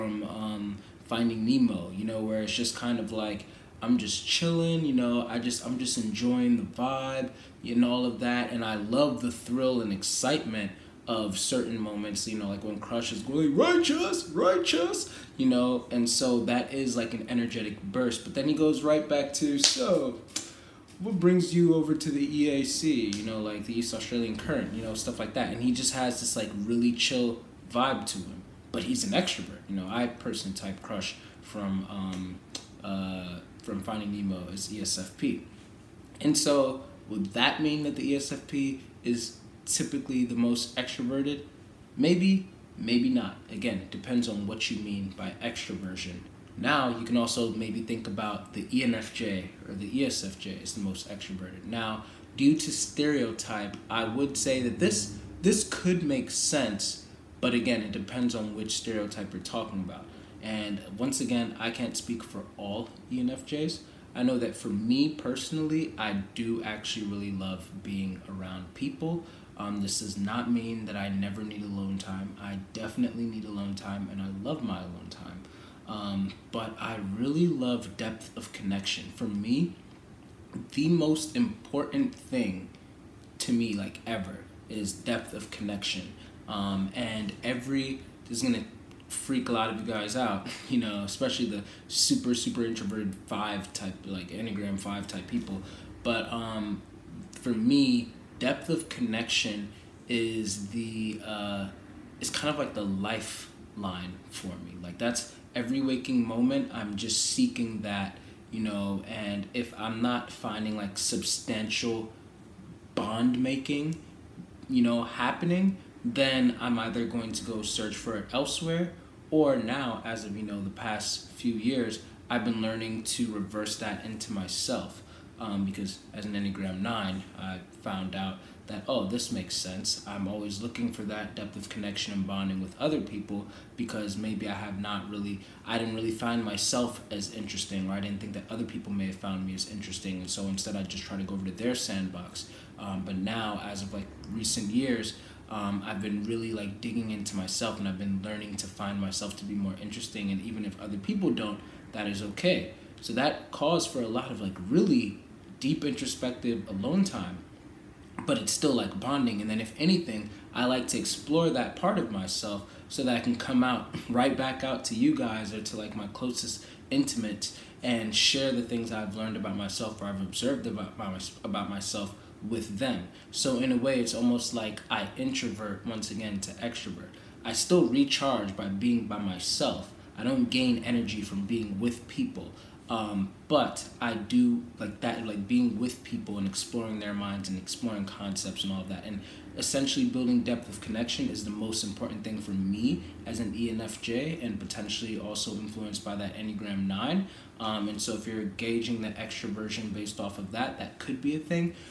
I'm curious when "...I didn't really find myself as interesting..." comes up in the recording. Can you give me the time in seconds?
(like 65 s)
135 s.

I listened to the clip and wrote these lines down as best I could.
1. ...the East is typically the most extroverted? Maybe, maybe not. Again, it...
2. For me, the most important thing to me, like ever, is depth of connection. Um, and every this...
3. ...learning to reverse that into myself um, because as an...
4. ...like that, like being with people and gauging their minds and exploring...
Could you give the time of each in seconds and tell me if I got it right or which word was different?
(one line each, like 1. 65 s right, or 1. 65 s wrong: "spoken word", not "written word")
1. 37 s wrong: "ESFP", not "East"
2. 79 s right
3. 122 s right
4. 184 s wrong: "exploring", not "gauging".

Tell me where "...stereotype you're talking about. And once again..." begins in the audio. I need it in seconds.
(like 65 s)
58 s.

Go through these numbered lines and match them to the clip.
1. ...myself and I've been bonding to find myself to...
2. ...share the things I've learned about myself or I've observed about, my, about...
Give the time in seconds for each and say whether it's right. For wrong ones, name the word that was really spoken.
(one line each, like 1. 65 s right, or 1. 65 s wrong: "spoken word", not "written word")
1. 147 s wrong: "learning", not "bonding"
2. 168 s right.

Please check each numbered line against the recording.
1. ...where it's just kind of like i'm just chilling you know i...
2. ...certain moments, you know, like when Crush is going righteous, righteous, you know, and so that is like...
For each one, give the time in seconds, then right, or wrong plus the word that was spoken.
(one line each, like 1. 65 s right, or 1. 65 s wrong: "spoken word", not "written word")
1. 2 s right
2. 11 s right.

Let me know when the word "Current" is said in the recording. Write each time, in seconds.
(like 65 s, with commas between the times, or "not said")
24 s.